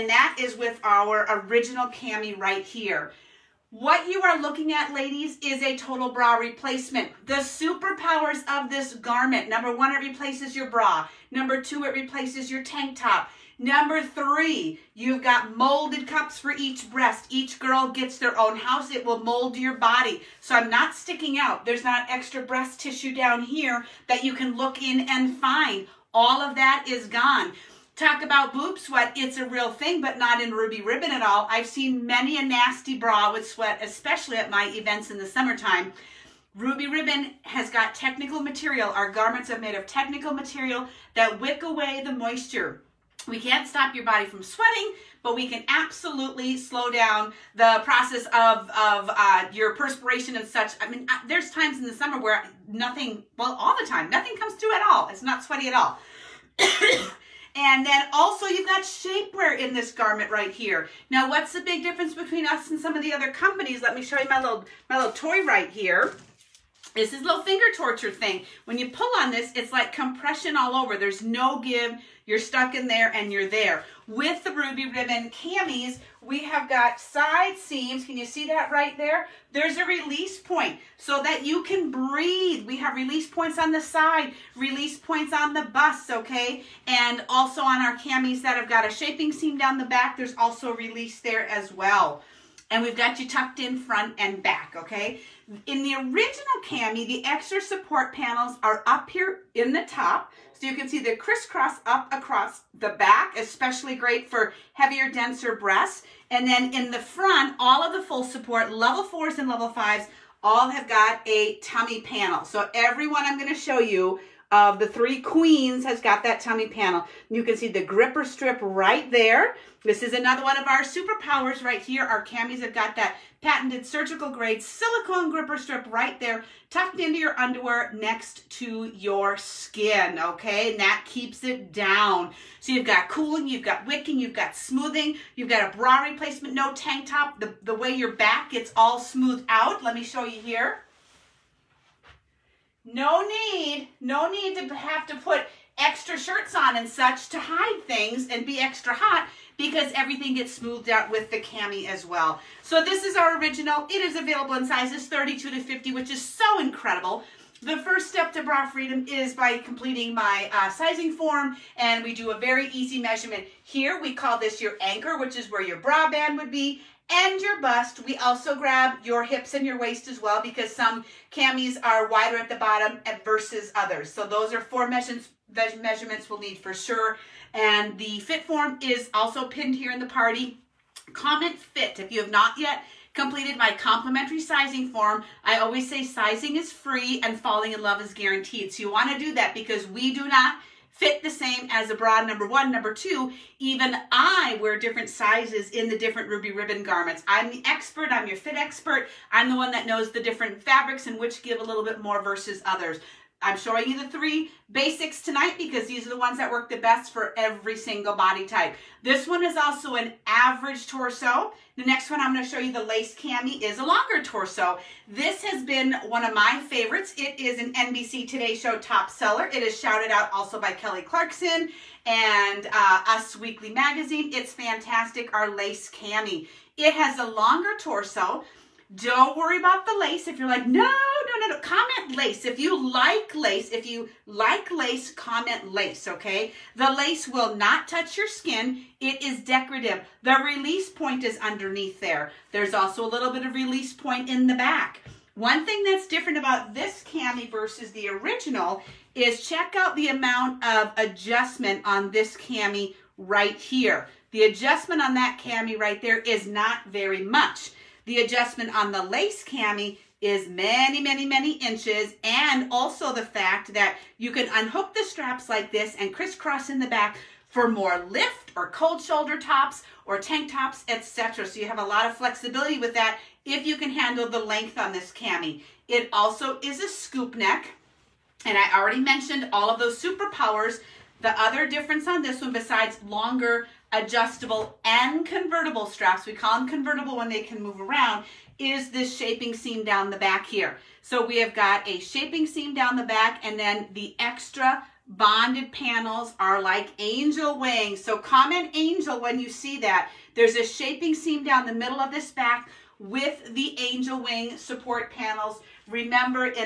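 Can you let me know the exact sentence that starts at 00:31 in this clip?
I've seen many a nasty bra with sweat, especially at my events in the summertime.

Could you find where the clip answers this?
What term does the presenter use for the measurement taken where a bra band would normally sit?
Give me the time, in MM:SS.
02:44.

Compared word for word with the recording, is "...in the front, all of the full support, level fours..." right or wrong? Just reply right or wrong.
right.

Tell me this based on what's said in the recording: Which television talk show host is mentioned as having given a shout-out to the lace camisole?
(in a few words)
Kelly Clarkson.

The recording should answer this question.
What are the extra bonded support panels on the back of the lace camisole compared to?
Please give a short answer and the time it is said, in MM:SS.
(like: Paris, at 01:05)
angel wings, at 04:56.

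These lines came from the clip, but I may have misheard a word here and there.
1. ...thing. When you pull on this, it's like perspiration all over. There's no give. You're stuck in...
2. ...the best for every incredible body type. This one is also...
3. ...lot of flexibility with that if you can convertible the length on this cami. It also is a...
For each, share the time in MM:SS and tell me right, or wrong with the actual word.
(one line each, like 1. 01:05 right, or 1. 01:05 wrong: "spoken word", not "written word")
1. 01:08 wrong: "compression", not "perspiration"
2. 03:26 wrong: "single", not "incredible"
3. 04:31 wrong: "handle", not "convertible".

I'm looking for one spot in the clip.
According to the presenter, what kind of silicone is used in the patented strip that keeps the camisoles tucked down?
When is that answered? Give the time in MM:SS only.
02:03.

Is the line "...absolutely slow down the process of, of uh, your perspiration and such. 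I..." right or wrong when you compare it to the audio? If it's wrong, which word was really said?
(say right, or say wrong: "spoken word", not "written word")
right.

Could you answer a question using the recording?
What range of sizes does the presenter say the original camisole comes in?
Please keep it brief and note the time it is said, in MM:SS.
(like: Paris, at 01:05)
32 to 50, at 02:35.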